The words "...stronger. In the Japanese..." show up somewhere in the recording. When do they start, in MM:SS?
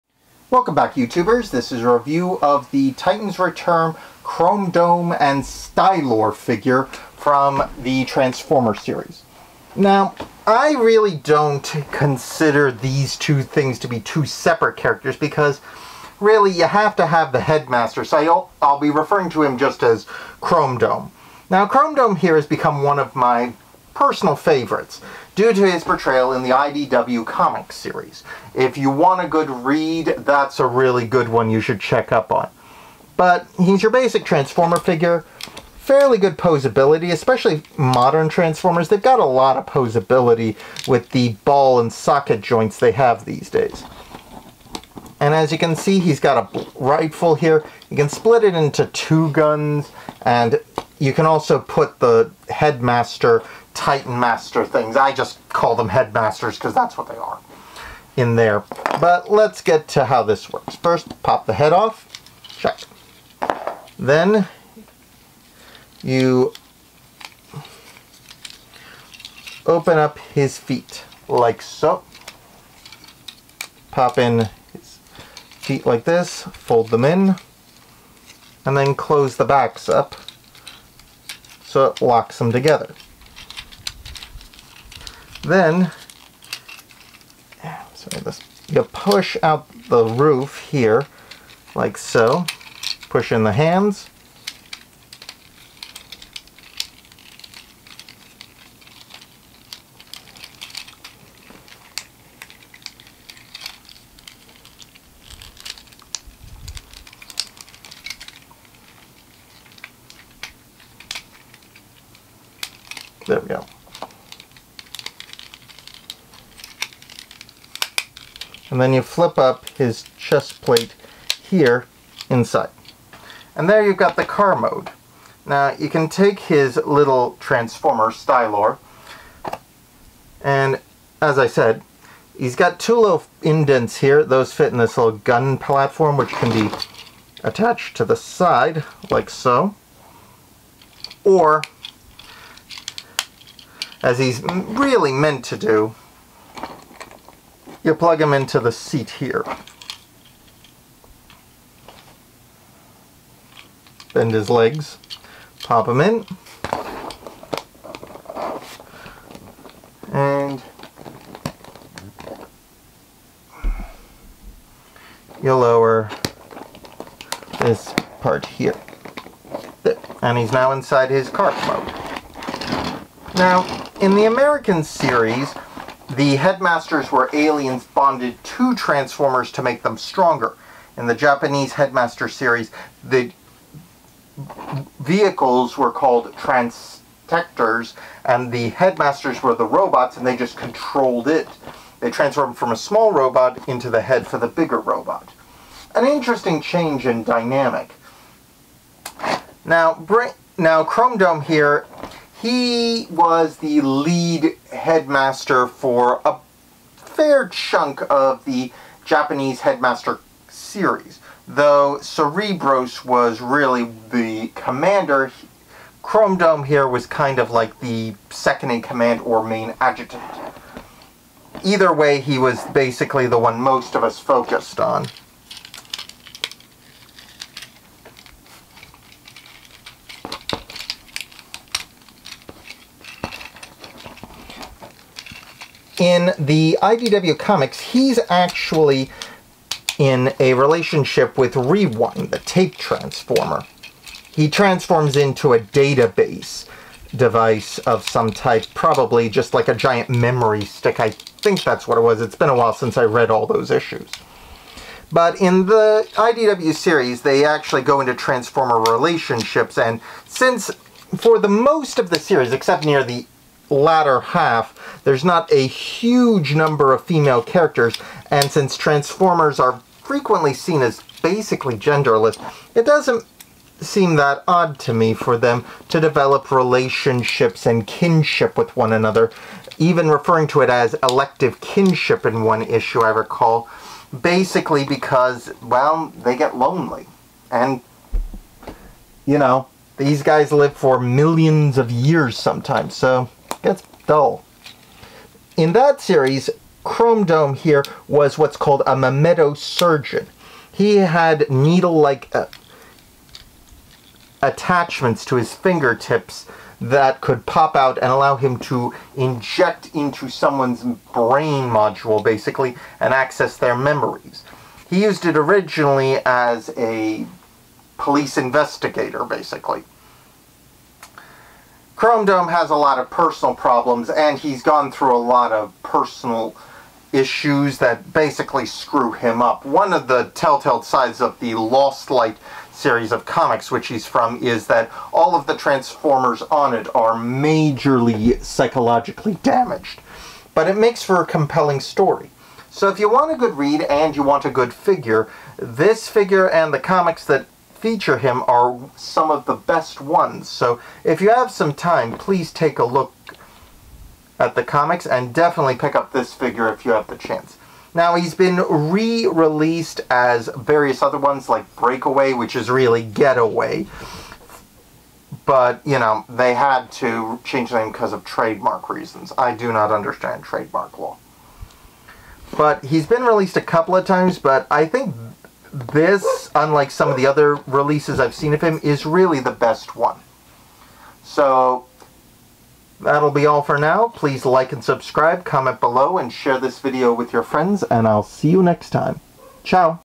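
02:59.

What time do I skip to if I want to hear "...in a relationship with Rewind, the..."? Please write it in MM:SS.
03:59.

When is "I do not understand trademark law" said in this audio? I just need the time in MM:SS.
06:09.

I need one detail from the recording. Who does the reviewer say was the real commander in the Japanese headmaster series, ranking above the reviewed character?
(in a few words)
Cerebros.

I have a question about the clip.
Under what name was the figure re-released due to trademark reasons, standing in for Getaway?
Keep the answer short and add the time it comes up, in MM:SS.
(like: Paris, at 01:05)
Breakaway, at 06:01.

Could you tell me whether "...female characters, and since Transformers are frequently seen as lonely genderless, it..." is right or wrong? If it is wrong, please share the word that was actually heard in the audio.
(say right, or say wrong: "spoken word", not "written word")
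wrong: "basically", not "lonely".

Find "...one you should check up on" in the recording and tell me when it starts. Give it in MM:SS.
00:31.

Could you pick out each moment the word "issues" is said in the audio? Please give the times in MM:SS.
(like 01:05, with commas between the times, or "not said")
04:13, 04:42, 05:27.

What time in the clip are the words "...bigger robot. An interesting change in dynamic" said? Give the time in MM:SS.
03:14.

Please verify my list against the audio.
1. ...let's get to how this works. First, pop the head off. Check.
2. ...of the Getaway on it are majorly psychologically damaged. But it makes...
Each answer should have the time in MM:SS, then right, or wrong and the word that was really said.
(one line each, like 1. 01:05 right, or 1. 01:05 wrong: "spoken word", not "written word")
1. 00:59 right
2. 05:35 wrong: "Transformers", not "Getaway".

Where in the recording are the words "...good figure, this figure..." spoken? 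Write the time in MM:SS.
05:44.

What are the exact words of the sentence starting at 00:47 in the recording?
You can split it into two guns, and you can also put the headmaster Titan Master things.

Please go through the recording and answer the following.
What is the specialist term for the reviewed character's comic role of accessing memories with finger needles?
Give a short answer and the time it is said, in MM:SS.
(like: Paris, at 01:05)
Mnemosurgeon, at 04:58.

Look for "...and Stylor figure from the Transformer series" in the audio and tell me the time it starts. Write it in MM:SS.
00:05.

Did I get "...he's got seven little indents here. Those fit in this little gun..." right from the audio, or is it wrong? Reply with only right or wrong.
wrong.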